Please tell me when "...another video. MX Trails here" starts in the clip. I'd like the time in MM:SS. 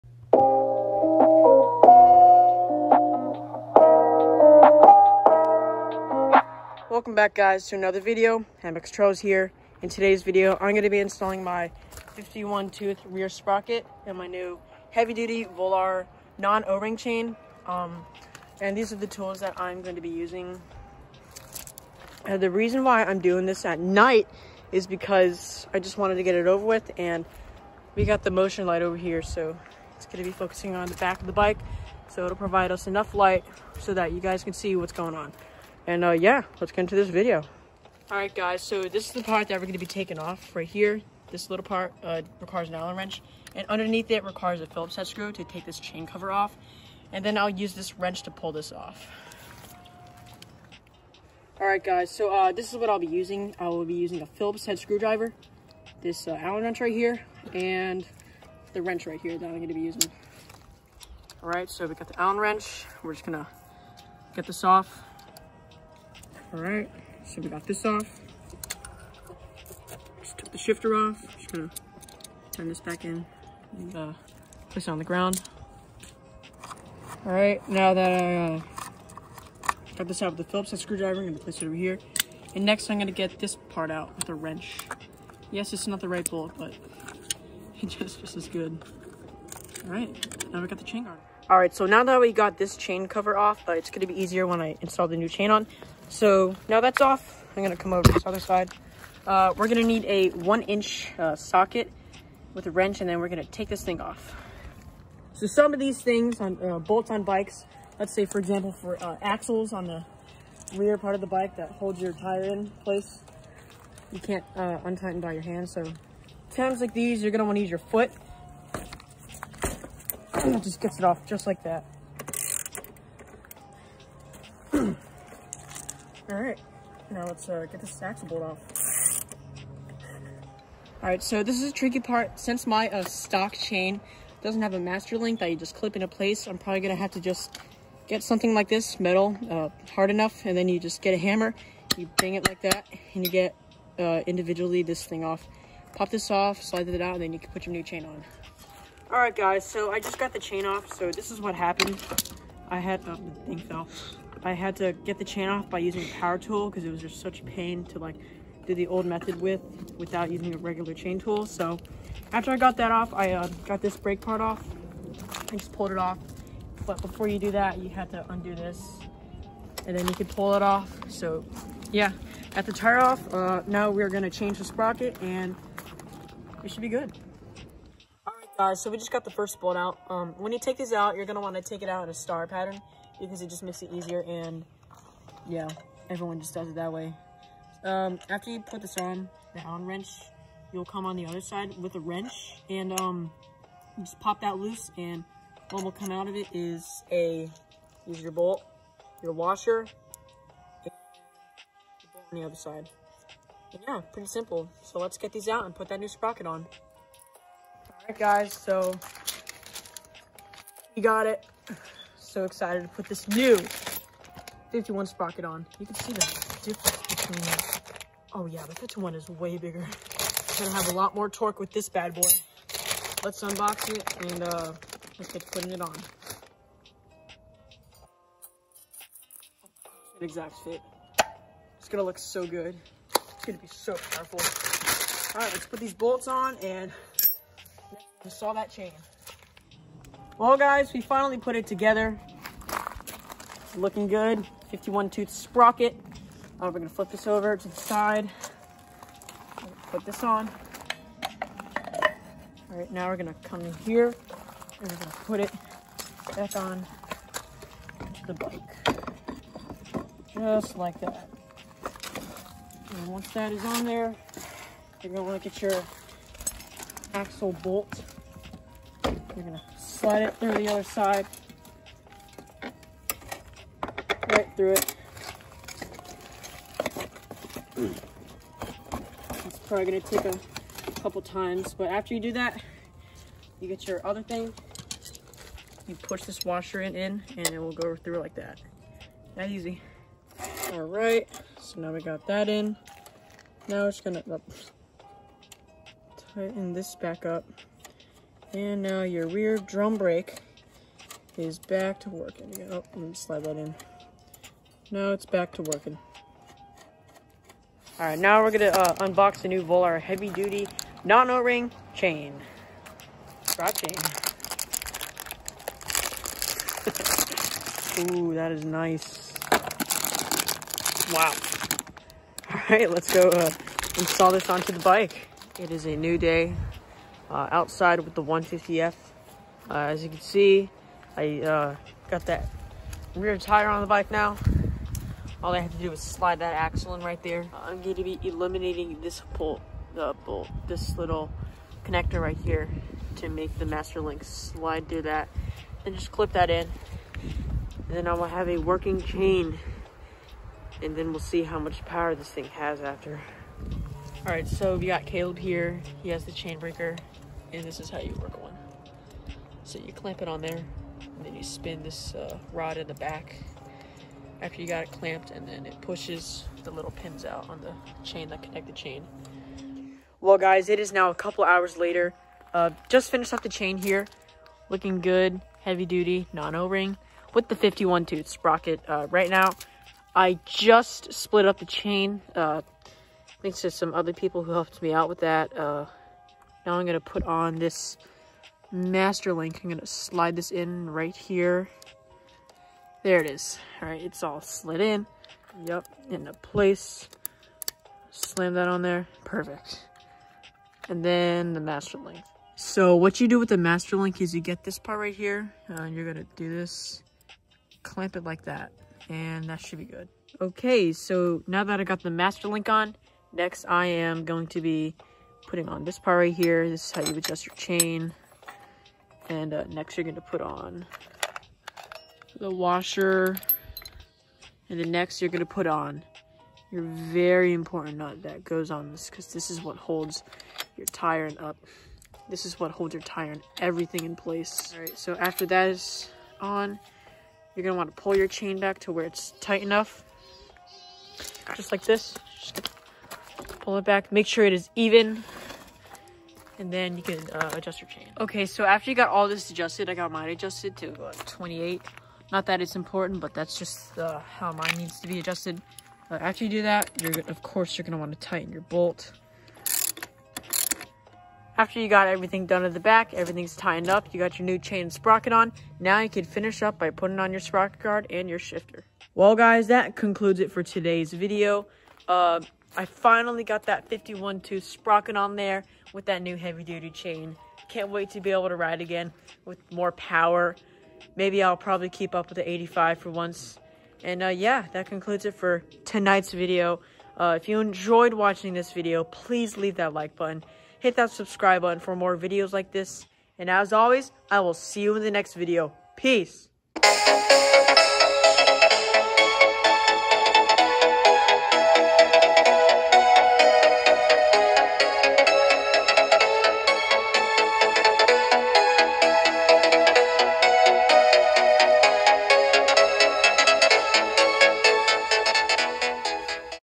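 00:07.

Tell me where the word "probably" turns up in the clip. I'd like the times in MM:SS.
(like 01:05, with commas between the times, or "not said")
02:16, 04:39, 08:01.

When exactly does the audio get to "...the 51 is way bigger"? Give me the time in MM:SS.
03:38.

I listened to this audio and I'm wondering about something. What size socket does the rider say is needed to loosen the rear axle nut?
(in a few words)
one inch.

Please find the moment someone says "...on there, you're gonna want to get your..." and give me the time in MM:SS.
04:23.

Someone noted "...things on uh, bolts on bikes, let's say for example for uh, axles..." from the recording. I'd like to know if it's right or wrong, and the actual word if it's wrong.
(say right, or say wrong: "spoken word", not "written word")
right.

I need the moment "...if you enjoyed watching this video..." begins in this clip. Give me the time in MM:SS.
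08:07.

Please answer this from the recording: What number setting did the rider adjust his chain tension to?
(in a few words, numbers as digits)
28.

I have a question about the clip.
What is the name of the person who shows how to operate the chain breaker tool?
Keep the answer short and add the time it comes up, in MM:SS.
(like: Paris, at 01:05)
Caleb, at 05:55.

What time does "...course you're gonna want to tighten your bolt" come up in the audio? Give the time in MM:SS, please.
07:37.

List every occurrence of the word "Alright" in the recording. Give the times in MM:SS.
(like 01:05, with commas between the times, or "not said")
02:06, 02:11, 02:29.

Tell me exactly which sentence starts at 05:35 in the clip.
All I have to do is slide that axle in right there.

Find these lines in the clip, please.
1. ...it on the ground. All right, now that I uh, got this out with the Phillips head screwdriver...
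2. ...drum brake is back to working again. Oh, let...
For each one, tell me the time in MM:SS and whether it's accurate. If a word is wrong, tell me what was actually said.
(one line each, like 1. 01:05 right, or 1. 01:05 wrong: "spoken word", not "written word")
1. 01:14 right
2. 04:59 right.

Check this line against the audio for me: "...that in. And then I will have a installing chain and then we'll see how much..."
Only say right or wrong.
wrong.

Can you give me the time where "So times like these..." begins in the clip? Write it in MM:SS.
01:55.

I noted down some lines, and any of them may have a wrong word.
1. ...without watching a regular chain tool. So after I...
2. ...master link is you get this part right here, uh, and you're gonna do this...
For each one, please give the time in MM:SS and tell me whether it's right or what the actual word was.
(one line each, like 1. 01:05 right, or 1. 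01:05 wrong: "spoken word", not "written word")
1. 02:39 wrong: "using", not "watching"
2. 06:43 right.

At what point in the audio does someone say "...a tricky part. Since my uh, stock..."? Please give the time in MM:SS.
02:11.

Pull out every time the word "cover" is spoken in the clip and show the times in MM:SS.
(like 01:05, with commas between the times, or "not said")
00:46, 01:33.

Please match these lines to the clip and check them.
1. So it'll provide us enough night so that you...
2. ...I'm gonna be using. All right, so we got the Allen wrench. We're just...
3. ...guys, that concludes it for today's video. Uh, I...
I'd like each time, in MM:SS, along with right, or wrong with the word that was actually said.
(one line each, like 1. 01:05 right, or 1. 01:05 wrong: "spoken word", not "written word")
1. 00:32 wrong: "light", not "night"
2. 00:59 right
3. 07:49 right.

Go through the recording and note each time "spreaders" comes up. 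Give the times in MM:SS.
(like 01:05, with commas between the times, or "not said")
not said.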